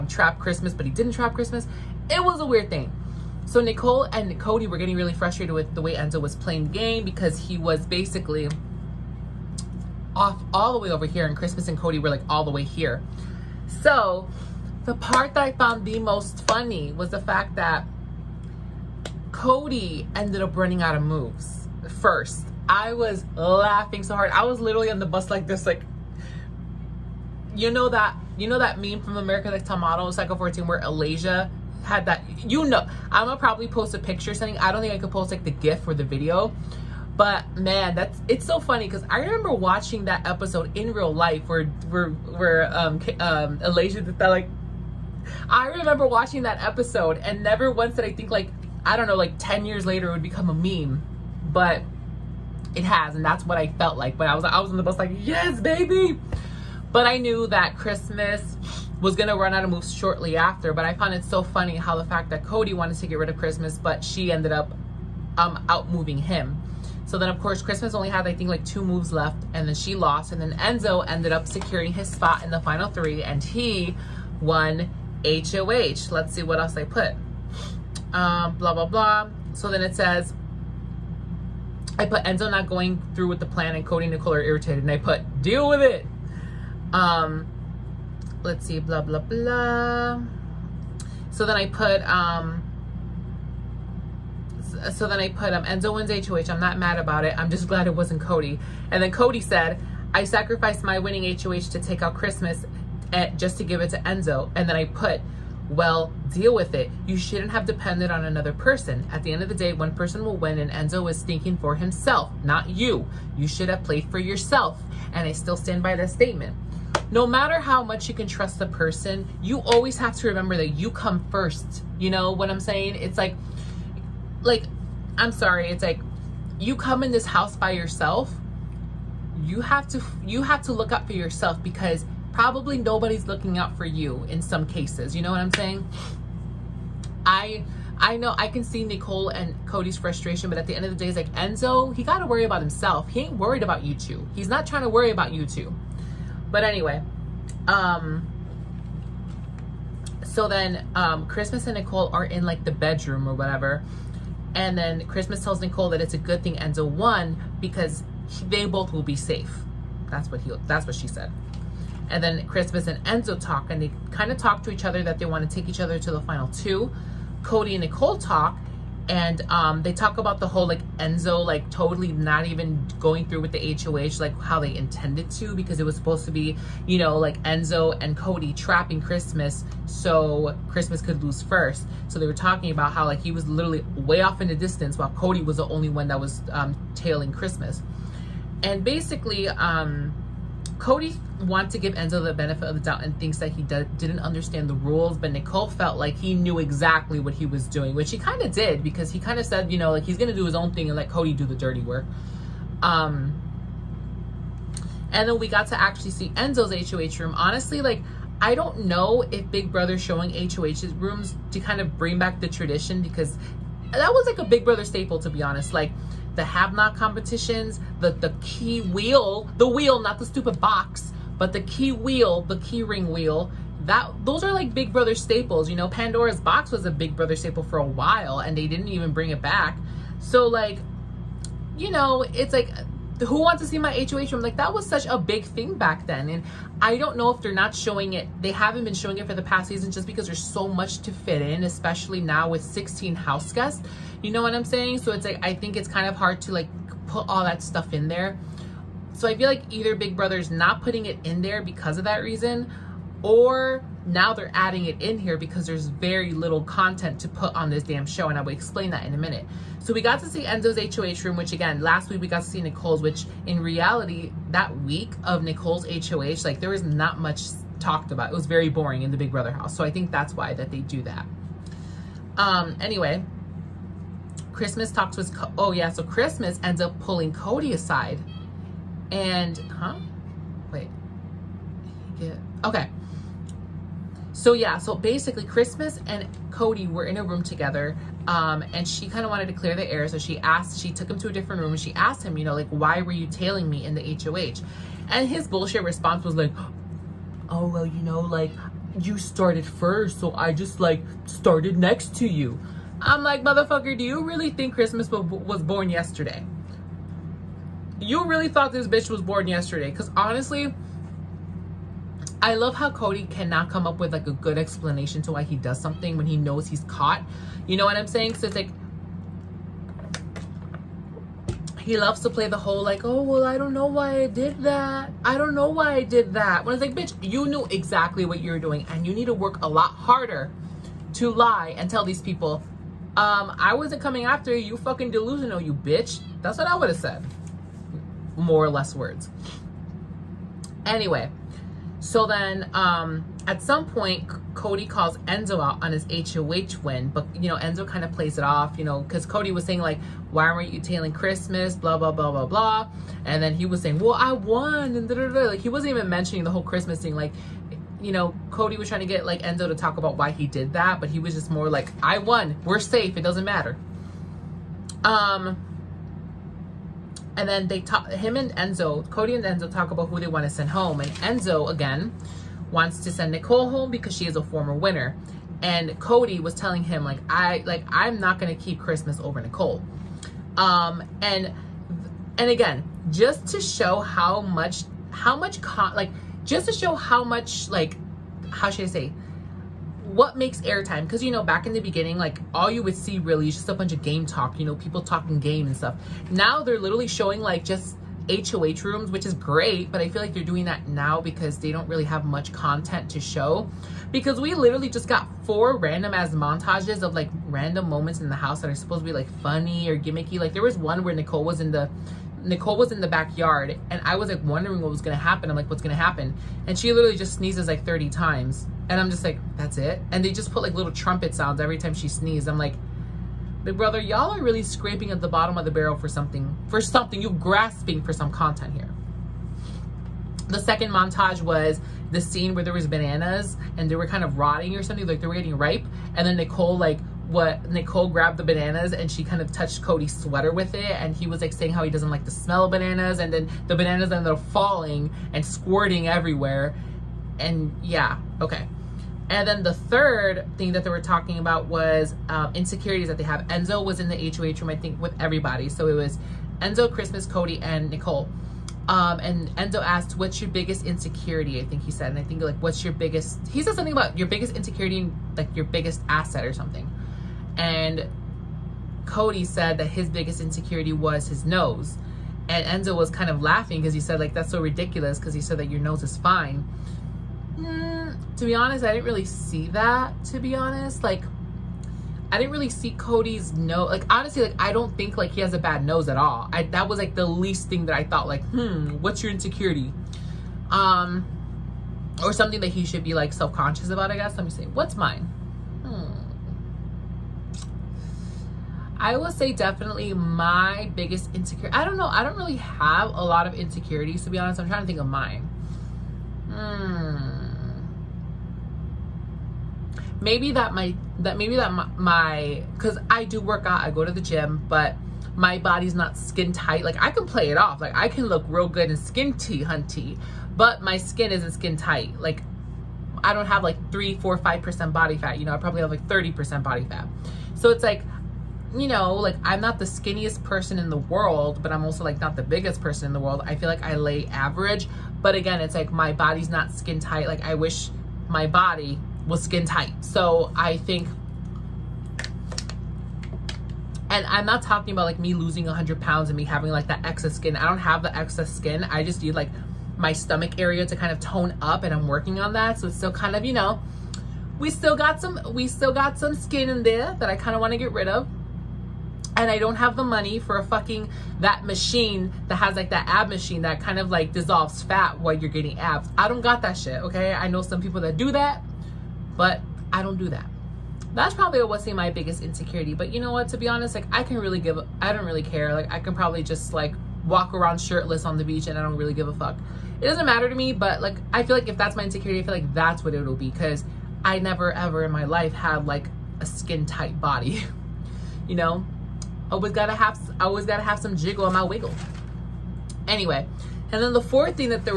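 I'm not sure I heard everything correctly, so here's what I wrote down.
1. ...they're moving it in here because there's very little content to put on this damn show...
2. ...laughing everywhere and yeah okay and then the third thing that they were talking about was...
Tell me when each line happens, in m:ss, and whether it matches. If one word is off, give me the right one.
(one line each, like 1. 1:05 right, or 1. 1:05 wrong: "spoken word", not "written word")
1. 4:14 wrong: "adding", not "moving"
2. 7:25 wrong: "squirting", not "laughing".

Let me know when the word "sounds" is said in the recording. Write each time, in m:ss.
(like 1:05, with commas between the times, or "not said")
7:01.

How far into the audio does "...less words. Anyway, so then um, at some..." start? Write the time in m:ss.
5:38.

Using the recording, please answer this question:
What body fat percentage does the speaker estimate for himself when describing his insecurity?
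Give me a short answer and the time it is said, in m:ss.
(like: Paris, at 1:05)
30%, at 8:46.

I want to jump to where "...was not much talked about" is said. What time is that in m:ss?
4:26.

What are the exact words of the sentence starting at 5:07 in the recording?
You really thought this bitch was born yesterday?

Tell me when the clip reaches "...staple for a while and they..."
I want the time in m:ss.
3:47.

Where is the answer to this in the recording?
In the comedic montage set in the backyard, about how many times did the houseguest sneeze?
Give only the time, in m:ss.
6:57.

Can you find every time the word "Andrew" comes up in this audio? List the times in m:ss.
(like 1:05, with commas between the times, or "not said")
not said.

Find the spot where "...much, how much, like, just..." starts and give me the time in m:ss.
6:24.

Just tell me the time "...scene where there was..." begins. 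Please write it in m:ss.
7:12.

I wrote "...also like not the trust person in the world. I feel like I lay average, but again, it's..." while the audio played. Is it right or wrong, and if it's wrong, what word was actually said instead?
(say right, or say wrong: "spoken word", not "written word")
wrong: "biggest", not "trust".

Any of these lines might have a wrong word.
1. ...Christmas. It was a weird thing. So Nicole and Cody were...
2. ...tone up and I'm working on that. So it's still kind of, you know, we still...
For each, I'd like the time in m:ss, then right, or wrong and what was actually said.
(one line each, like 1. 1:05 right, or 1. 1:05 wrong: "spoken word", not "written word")
1. 0:01 right
2. 9:11 right.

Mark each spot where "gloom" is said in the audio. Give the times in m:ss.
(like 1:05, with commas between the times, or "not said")
not said.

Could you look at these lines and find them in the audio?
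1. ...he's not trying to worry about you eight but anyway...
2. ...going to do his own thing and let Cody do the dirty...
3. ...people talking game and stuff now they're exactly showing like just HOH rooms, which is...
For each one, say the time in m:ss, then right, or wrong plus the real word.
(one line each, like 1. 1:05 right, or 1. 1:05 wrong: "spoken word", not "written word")
1. 2:24 wrong: "two", not "eight"
2. 3:20 right
3. 6:34 wrong: "literally", not "exactly".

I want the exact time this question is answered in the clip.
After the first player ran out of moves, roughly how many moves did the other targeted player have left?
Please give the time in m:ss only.
1:08.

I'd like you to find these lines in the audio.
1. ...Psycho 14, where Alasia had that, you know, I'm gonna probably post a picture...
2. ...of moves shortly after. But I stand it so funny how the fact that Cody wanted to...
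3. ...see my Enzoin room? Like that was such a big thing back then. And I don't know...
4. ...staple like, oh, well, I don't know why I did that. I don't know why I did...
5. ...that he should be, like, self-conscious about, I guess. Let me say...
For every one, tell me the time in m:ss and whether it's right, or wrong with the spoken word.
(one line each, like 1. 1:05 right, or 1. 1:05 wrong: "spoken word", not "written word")
1. 0:30 right
2. 0:59 wrong: "found", not "stand"
3. 3:53 wrong: "HOH", not "Enzoin"
4. 5:22 wrong: "whole", not "staple"
5. 8:12 right.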